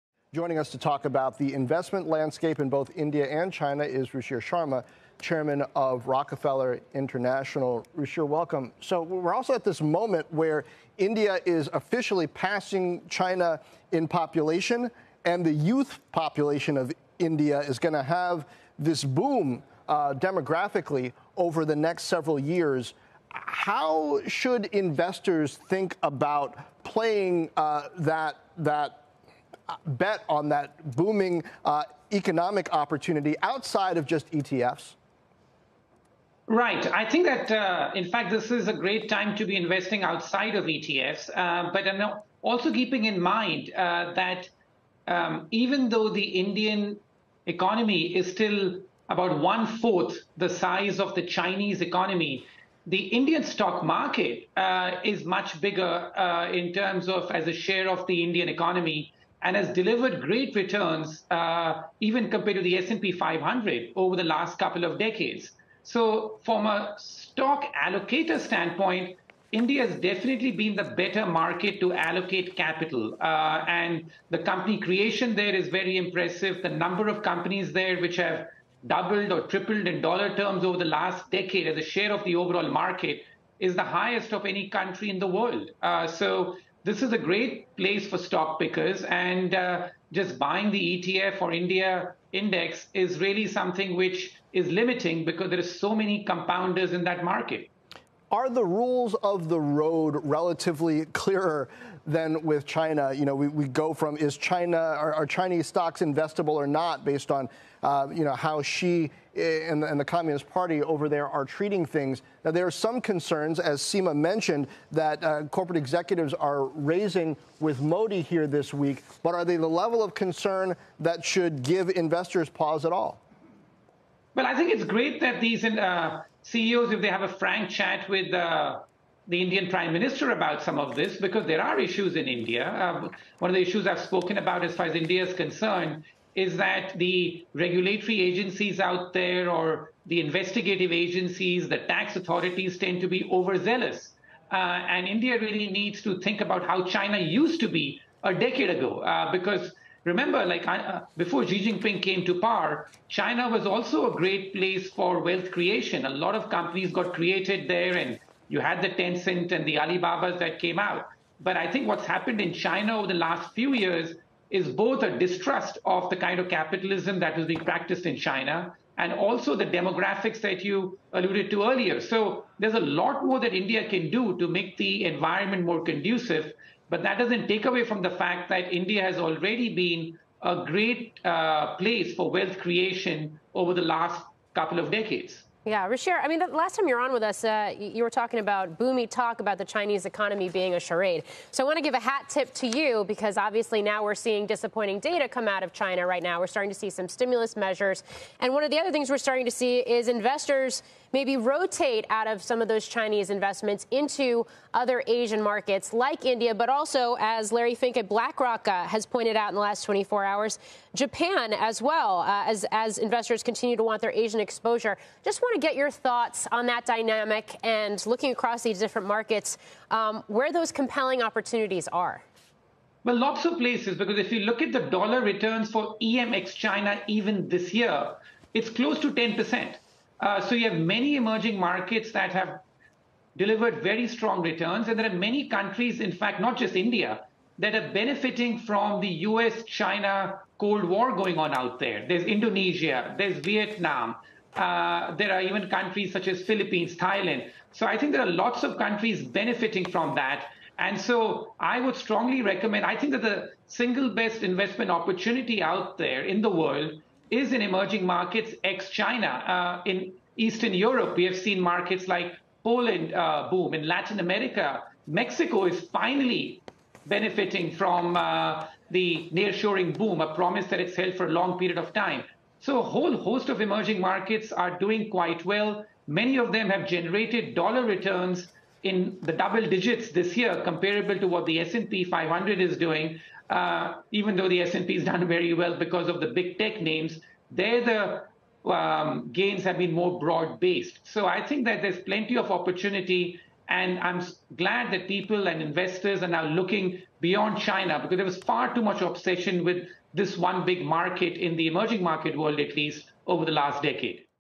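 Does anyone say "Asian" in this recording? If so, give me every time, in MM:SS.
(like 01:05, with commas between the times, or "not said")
03:25, 03:34.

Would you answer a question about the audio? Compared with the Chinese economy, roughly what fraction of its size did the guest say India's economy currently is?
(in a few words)
one fourth.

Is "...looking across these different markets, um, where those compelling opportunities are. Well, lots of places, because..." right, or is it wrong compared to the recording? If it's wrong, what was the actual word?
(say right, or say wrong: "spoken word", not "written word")
right.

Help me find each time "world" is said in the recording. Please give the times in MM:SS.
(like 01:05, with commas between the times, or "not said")
01:25, 04:16, 05:02.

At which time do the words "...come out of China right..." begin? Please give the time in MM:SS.
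03:15.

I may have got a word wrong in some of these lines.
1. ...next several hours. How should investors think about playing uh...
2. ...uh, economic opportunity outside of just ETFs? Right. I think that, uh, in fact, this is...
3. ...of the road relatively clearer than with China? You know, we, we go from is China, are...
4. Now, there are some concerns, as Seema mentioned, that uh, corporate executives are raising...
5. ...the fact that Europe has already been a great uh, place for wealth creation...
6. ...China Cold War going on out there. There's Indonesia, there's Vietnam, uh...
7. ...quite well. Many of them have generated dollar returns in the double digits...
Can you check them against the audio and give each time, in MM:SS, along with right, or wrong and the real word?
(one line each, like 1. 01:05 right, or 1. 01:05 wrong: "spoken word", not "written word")
1. 00:21 wrong: "years", not "hours"
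2. 00:31 right
3. 01:39 right
4. 01:52 right
5. 02:58 wrong: "India", not "Europe"
6. 03:59 right
7. 04:35 right.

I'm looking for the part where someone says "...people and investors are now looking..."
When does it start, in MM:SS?
04:55.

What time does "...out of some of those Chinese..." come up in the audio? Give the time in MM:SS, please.
03:22.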